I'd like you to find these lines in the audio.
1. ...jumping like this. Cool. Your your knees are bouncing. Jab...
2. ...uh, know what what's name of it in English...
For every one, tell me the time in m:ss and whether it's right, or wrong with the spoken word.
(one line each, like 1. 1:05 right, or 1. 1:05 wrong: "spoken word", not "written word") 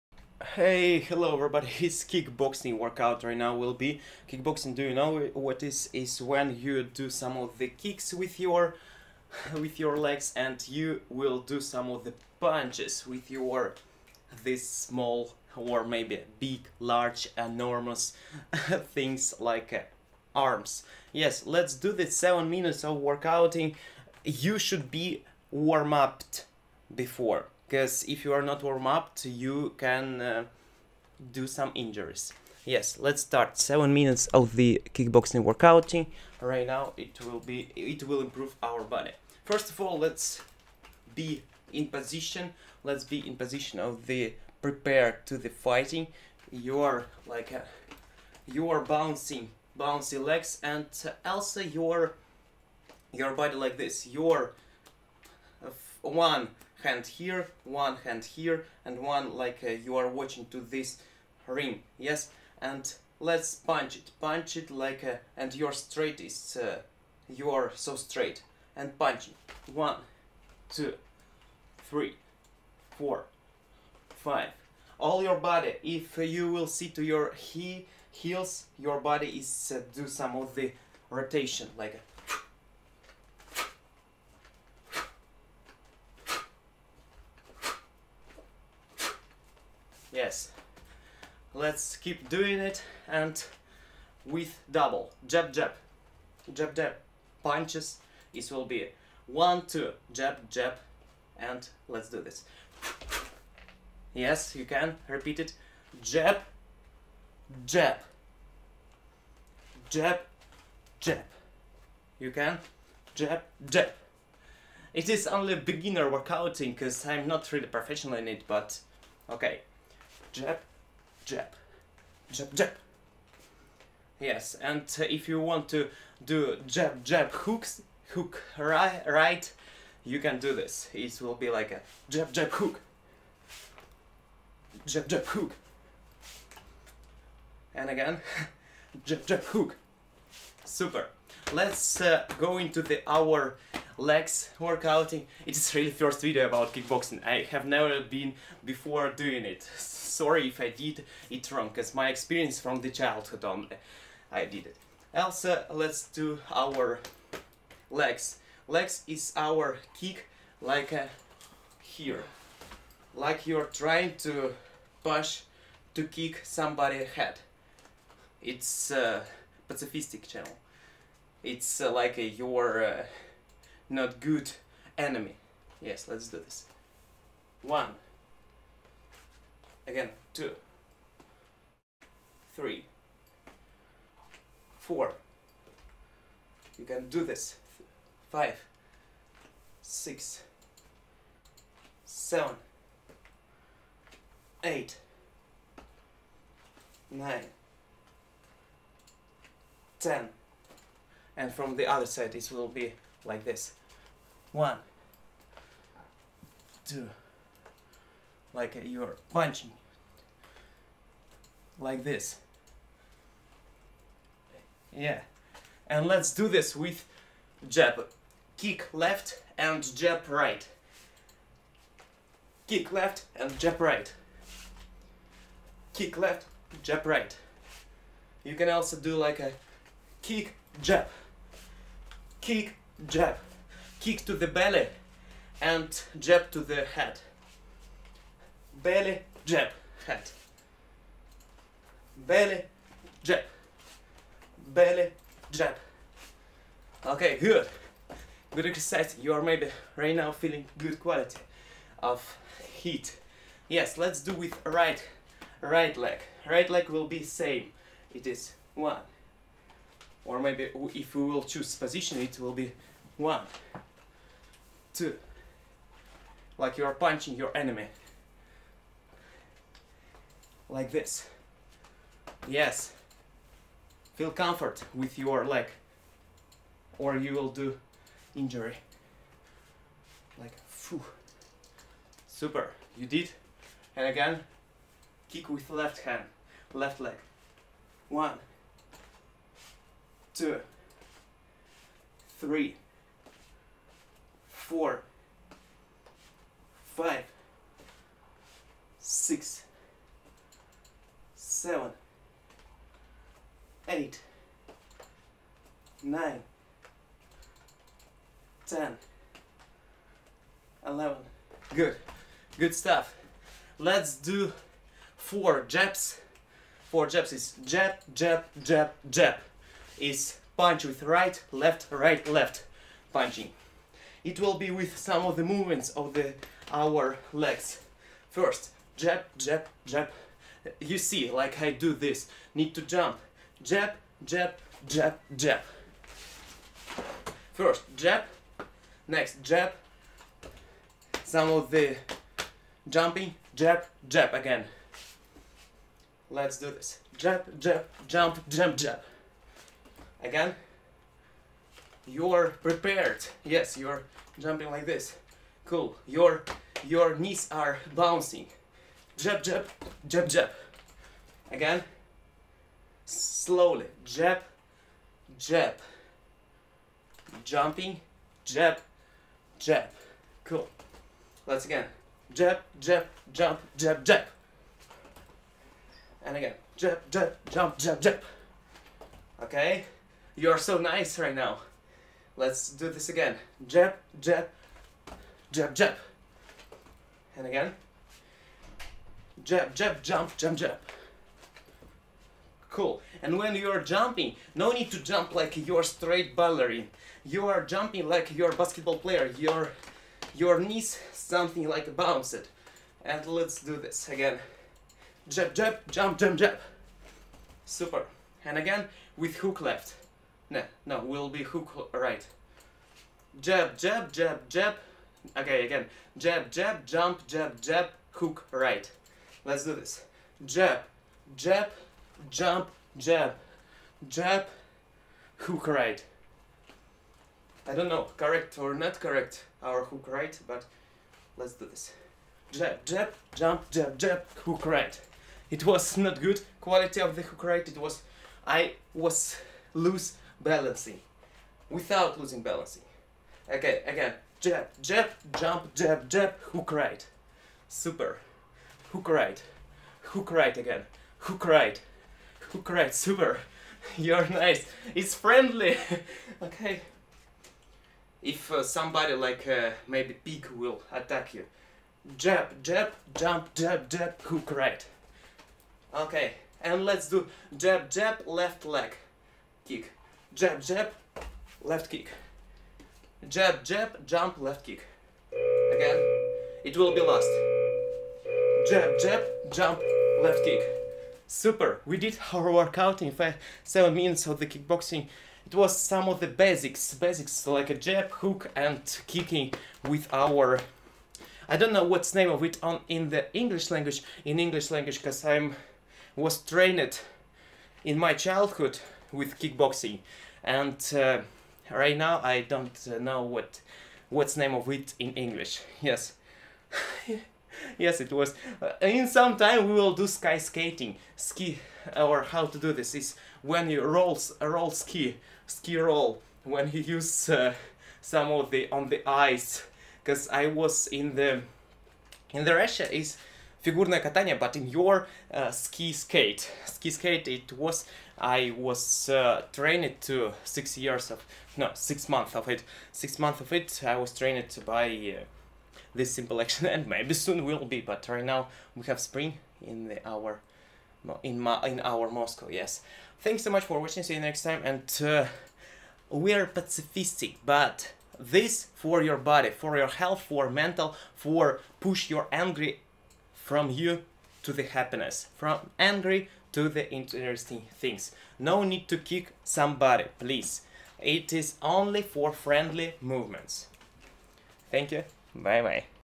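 1. 5:54 right
2. 8:22 right.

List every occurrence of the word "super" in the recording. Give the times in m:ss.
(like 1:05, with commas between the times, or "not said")
2:20, 4:42, 6:47, 7:27, 7:32, 8:01.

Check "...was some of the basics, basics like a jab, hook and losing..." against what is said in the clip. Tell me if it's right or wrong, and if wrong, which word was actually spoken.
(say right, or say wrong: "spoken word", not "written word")
wrong: "kicking", not "losing".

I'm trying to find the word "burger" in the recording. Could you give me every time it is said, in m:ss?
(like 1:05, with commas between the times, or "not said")
not said.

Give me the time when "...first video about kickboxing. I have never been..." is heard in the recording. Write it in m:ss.
2:25.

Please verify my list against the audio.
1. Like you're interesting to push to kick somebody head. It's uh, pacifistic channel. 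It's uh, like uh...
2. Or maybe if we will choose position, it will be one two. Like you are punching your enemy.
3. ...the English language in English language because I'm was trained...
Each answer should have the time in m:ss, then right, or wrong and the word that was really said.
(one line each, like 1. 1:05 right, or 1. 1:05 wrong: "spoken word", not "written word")
1. 2:43 wrong: "trying", not "interesting"
2. 4:20 right
3. 8:13 right.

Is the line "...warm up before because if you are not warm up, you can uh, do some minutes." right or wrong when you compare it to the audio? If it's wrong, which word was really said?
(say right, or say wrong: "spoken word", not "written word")
wrong: "injuries", not "minutes".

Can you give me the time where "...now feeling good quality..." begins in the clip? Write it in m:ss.
4:10.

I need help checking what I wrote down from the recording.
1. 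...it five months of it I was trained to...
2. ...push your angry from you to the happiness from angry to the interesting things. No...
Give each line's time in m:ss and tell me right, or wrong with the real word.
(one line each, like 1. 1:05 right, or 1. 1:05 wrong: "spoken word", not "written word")
1. 8:52 wrong: "six", not "five"
2. 9:11 right.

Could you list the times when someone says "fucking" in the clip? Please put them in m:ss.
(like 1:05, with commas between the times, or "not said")
not said.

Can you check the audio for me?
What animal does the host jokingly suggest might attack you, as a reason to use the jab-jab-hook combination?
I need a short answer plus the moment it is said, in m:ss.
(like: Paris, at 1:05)
Pig, at 7:40.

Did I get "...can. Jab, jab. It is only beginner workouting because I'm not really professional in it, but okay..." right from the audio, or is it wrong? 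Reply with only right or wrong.
right.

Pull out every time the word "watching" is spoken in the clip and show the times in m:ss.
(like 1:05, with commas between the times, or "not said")
1:00, 9:03.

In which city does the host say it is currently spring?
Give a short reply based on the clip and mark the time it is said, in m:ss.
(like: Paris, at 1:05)
Moscow, at 9:02.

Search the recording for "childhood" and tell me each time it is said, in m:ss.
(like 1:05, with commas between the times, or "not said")
2:32, 8:18.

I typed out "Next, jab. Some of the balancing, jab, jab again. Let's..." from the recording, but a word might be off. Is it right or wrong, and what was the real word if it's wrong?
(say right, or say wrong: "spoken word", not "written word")
wrong: "jumping", not "balancing".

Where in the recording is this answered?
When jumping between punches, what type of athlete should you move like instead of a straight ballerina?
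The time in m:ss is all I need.
6:38.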